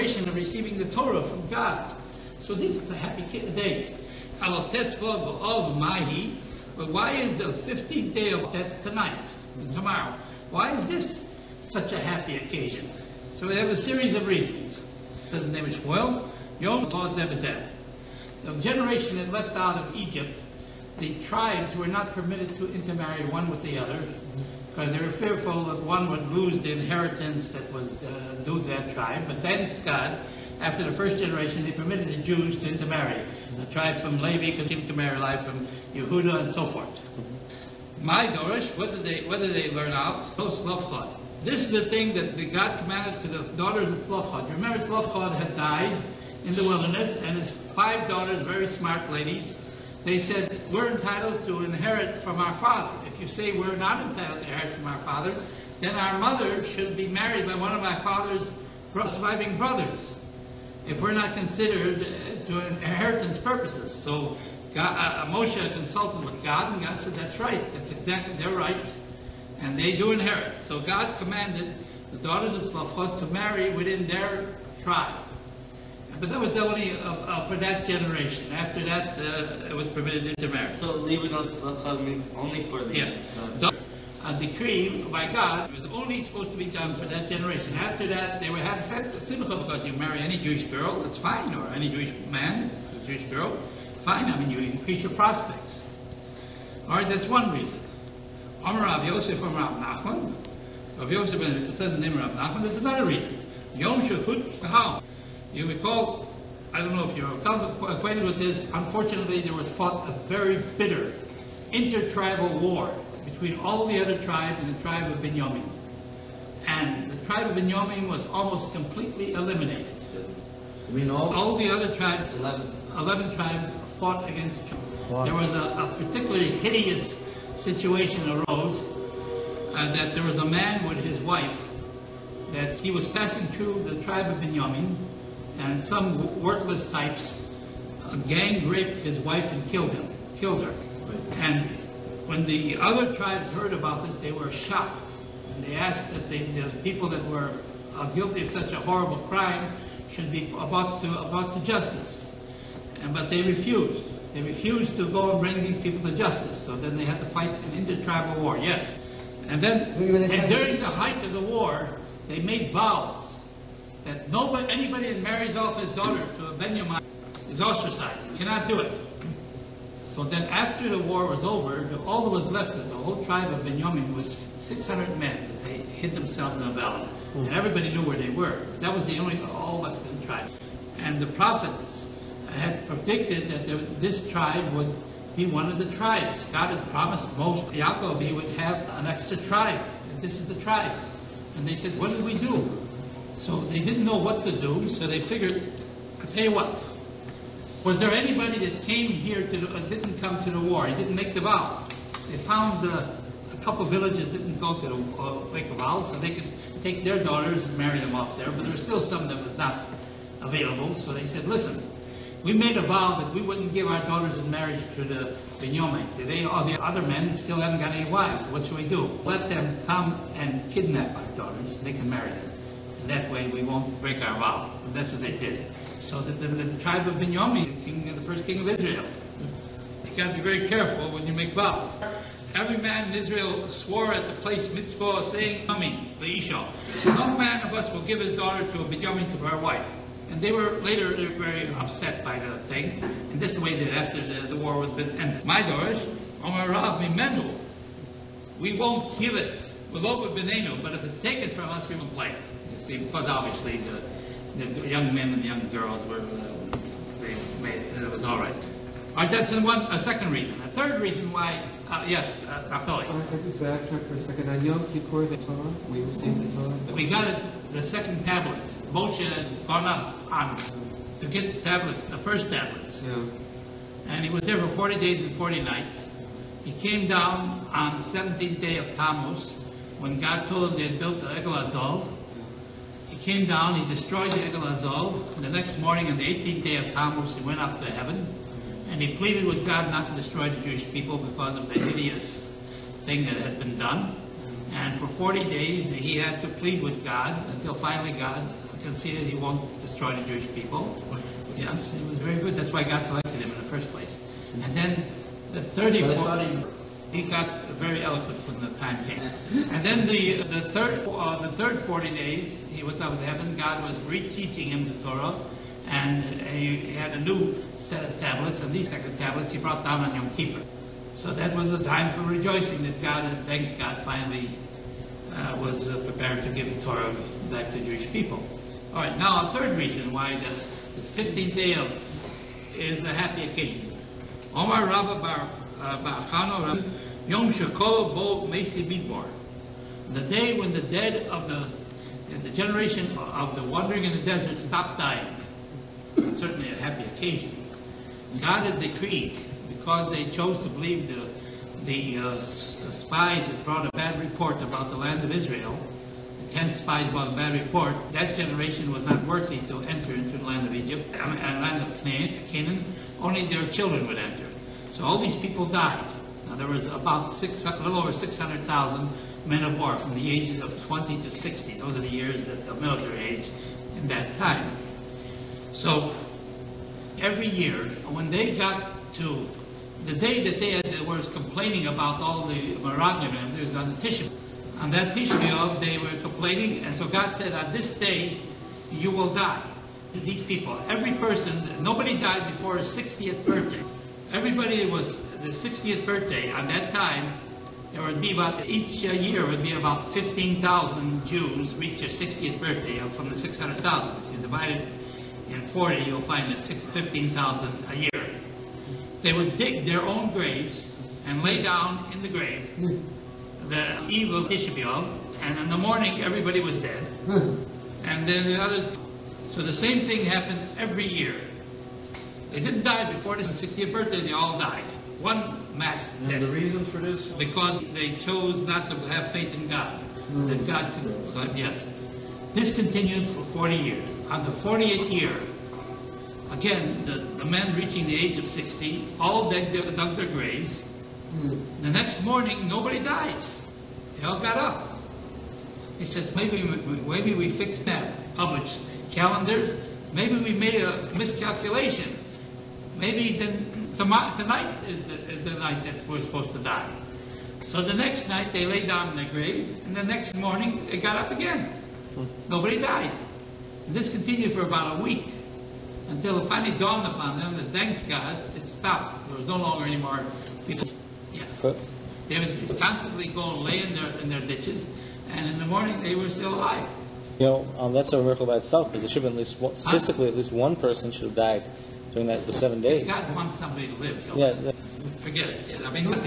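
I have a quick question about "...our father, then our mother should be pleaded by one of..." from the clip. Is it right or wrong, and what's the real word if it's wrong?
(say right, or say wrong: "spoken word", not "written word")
wrong: "married", not "pleaded".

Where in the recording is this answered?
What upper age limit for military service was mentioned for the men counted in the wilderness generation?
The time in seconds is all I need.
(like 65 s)
369 s.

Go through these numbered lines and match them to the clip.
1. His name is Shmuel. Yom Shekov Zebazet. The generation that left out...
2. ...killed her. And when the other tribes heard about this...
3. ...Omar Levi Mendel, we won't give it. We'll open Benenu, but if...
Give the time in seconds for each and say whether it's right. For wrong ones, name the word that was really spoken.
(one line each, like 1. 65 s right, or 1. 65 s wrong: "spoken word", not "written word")
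1. 15 s wrong: "Lord", not "Shekov"
2. 140 s right
3. 246 s wrong: "Rav", not "Levi".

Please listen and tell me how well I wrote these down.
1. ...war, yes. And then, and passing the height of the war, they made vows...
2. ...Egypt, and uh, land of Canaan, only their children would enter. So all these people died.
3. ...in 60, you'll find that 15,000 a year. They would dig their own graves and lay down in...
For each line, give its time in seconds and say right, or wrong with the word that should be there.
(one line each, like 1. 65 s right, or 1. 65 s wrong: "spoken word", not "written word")
1. 158 s wrong: "during", not "passing"
2. 360 s right
3. 405 s wrong: "40", not "60".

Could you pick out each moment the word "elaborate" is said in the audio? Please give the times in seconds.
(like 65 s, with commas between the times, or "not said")
not said.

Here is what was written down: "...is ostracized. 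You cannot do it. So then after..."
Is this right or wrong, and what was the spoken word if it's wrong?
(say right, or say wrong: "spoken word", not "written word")
right.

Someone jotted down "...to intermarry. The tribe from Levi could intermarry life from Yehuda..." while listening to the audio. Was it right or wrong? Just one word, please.
right.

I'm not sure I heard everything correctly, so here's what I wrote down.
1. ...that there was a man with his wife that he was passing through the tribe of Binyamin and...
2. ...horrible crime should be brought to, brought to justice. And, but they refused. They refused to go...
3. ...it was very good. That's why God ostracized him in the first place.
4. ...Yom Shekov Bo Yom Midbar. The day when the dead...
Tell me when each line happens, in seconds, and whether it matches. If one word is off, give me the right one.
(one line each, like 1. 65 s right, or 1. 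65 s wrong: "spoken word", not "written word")
1. 129 s right
2. 148 s right
3. 301 s wrong: "selected", not "ostracized"
4. 337 s wrong: "Mesi", not "Yom".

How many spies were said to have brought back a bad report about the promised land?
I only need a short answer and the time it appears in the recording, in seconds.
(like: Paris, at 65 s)
10, at 356 s.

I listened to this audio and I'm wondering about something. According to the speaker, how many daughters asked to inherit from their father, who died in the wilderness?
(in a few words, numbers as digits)
5.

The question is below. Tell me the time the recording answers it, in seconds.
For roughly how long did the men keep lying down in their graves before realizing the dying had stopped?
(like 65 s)
464 s.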